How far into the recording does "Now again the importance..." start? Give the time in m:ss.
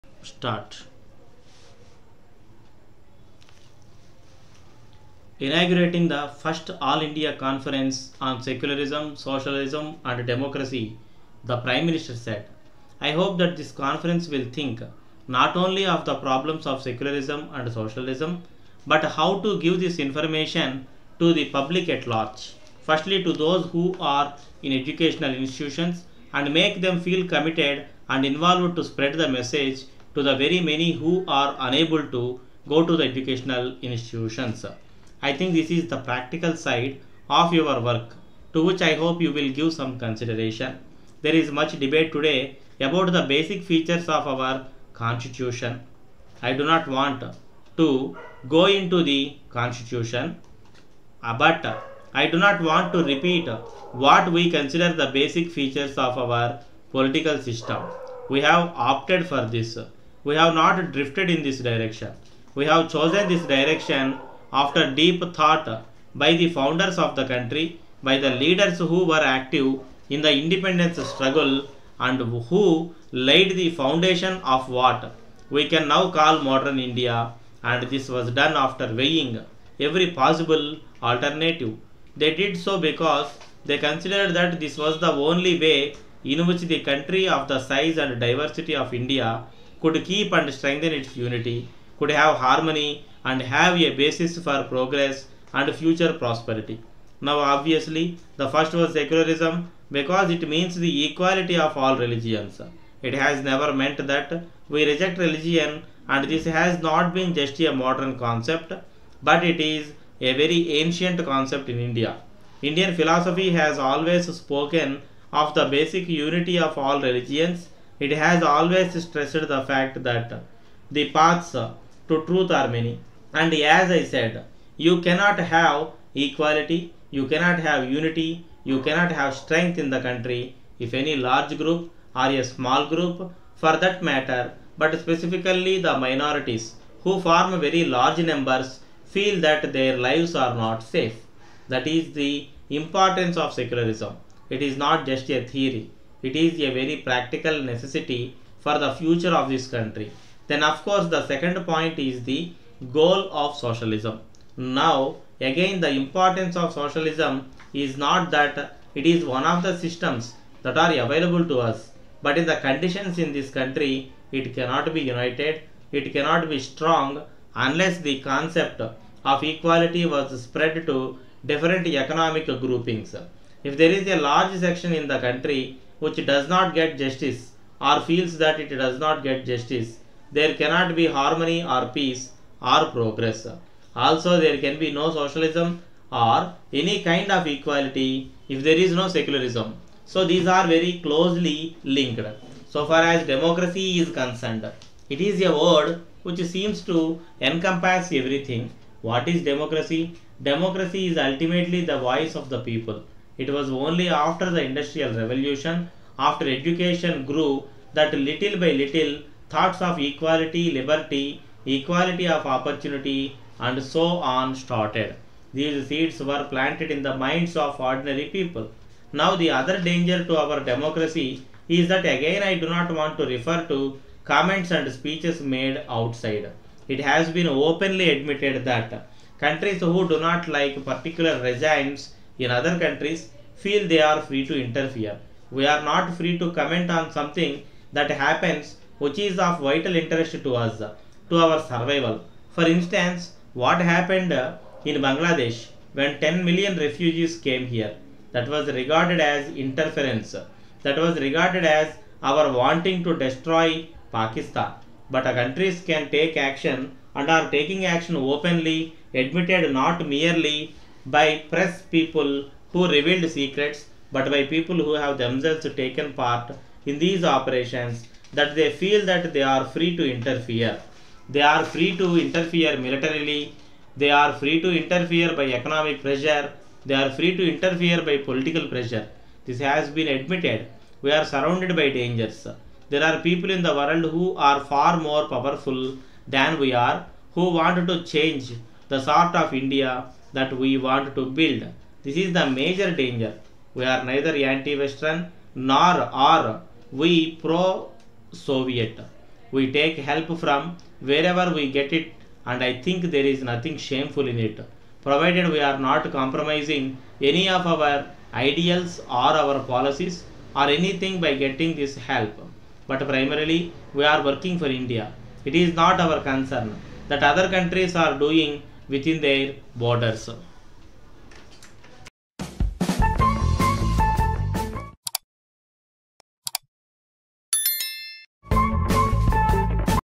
2:34.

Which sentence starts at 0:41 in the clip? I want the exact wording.
There is much debate today about the basic features of our constitution.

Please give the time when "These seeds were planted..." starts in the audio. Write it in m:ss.
3:35.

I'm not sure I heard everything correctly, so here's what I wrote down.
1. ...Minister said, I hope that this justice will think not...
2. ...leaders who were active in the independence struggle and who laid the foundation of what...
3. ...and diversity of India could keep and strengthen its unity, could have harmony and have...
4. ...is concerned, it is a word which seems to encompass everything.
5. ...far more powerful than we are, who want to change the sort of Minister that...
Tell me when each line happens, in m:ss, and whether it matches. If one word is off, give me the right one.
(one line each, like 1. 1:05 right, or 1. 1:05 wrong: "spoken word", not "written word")
1. 0:11 wrong: "conference", not "justice"
2. 1:08 right
3. 1:27 right
4. 3:13 right
5. 4:44 wrong: "India", not "Minister".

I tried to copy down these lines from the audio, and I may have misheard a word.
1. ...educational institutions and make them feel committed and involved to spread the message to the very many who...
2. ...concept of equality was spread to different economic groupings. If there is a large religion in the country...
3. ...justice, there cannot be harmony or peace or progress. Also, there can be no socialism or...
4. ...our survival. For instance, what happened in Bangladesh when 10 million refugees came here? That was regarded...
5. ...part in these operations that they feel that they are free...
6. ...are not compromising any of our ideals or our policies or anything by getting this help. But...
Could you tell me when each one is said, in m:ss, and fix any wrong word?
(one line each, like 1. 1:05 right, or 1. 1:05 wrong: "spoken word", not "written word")
1. 0:24 right
2. 2:48 wrong: "section", not "religion"
3. 2:59 right
4. 4:01 right
5. 4:26 right
6. 5:05 right.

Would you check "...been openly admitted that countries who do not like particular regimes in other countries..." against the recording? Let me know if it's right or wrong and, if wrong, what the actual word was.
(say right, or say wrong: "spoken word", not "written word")
right.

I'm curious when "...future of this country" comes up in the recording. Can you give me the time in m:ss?
2:28.